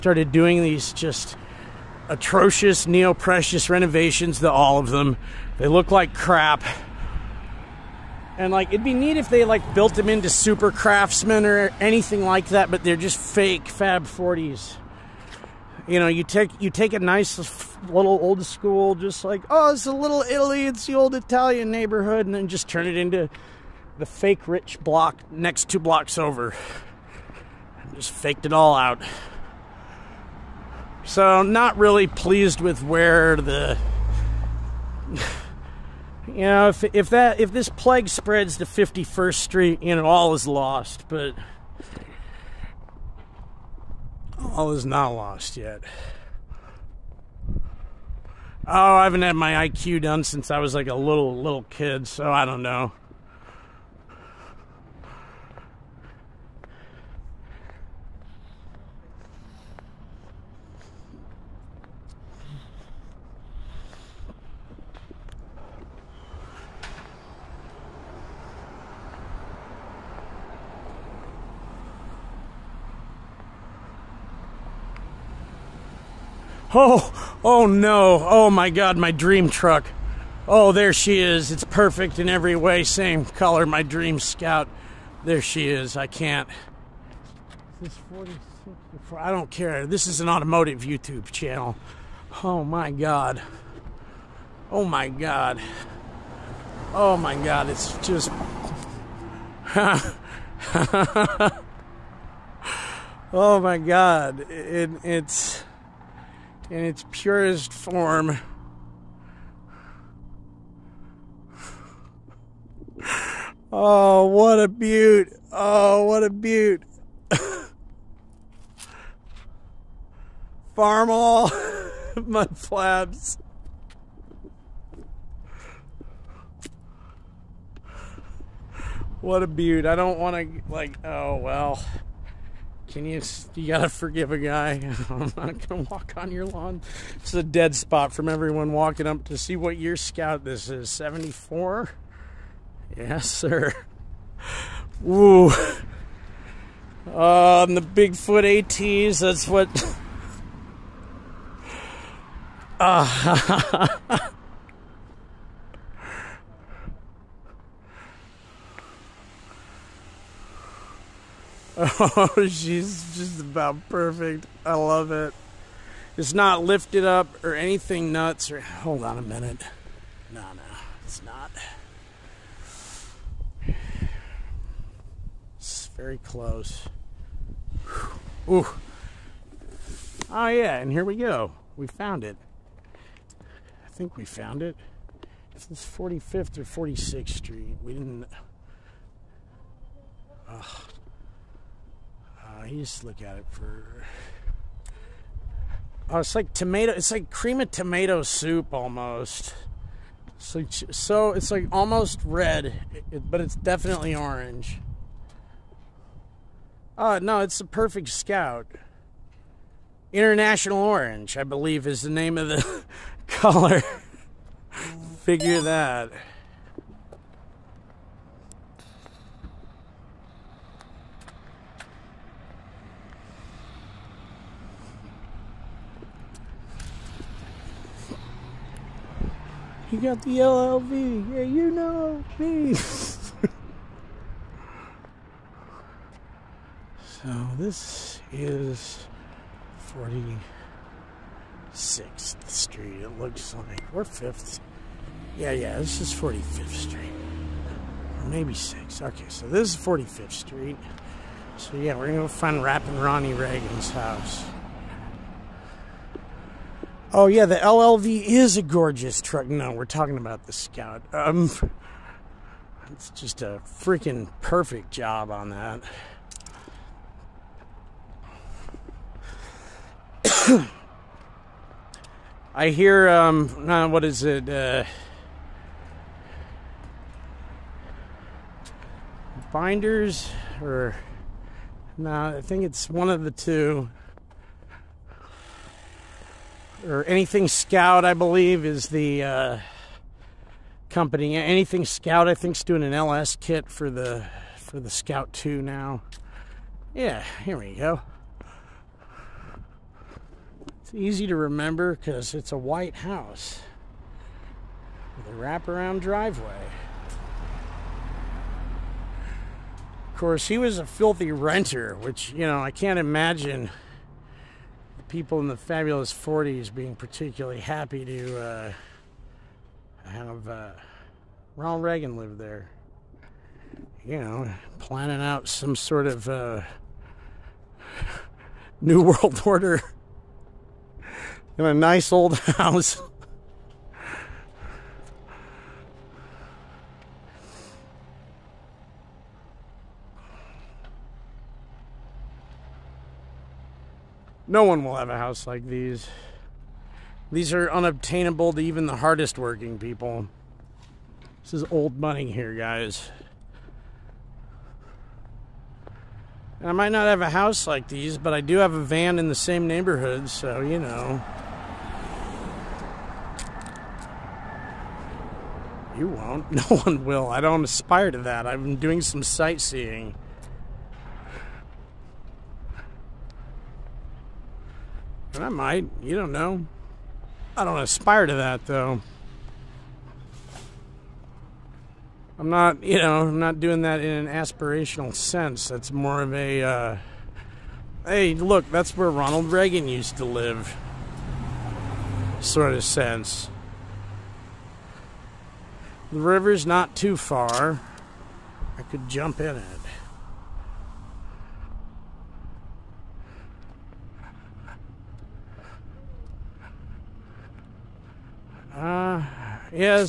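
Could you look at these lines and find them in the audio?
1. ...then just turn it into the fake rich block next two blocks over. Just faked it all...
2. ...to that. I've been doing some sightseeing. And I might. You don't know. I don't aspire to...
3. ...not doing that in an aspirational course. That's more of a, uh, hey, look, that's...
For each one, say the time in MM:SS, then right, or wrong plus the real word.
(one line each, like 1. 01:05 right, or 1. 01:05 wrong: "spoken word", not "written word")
1. 00:22 right
2. 06:08 right
3. 06:23 wrong: "sense", not "course".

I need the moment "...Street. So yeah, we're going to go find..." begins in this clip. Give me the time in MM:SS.
04:10.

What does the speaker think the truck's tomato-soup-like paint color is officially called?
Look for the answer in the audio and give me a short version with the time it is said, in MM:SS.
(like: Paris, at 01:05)
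International Orange, at 03:30.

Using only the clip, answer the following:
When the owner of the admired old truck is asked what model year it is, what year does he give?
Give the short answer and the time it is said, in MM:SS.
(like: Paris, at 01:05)
1974, at 02:20.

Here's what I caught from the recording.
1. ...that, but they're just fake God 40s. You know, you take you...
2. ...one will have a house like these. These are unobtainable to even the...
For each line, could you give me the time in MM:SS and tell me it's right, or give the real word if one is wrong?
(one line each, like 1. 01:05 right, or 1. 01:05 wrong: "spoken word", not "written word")
1. 00:12 wrong: "Fab", not "God"
2. 05:44 right.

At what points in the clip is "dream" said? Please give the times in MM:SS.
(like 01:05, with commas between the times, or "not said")
01:19, 01:23.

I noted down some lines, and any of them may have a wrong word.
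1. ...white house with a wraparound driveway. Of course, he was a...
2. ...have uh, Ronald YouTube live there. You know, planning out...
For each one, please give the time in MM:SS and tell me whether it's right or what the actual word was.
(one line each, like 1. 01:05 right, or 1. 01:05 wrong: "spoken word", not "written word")
1. 05:02 right
2. 05:20 wrong: "Reagan", not "YouTube".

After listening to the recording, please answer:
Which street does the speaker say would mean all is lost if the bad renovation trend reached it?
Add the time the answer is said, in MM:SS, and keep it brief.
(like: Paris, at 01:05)
51st Street, at 00:38.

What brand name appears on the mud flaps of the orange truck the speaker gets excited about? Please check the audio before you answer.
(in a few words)
Farmall.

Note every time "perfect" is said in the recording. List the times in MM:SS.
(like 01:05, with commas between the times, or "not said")
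01:21, 02:43, 03:27, 04:24.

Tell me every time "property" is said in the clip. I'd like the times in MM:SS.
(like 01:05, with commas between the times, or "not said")
not said.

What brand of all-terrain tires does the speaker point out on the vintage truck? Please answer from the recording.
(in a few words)
Bigfoot ATs.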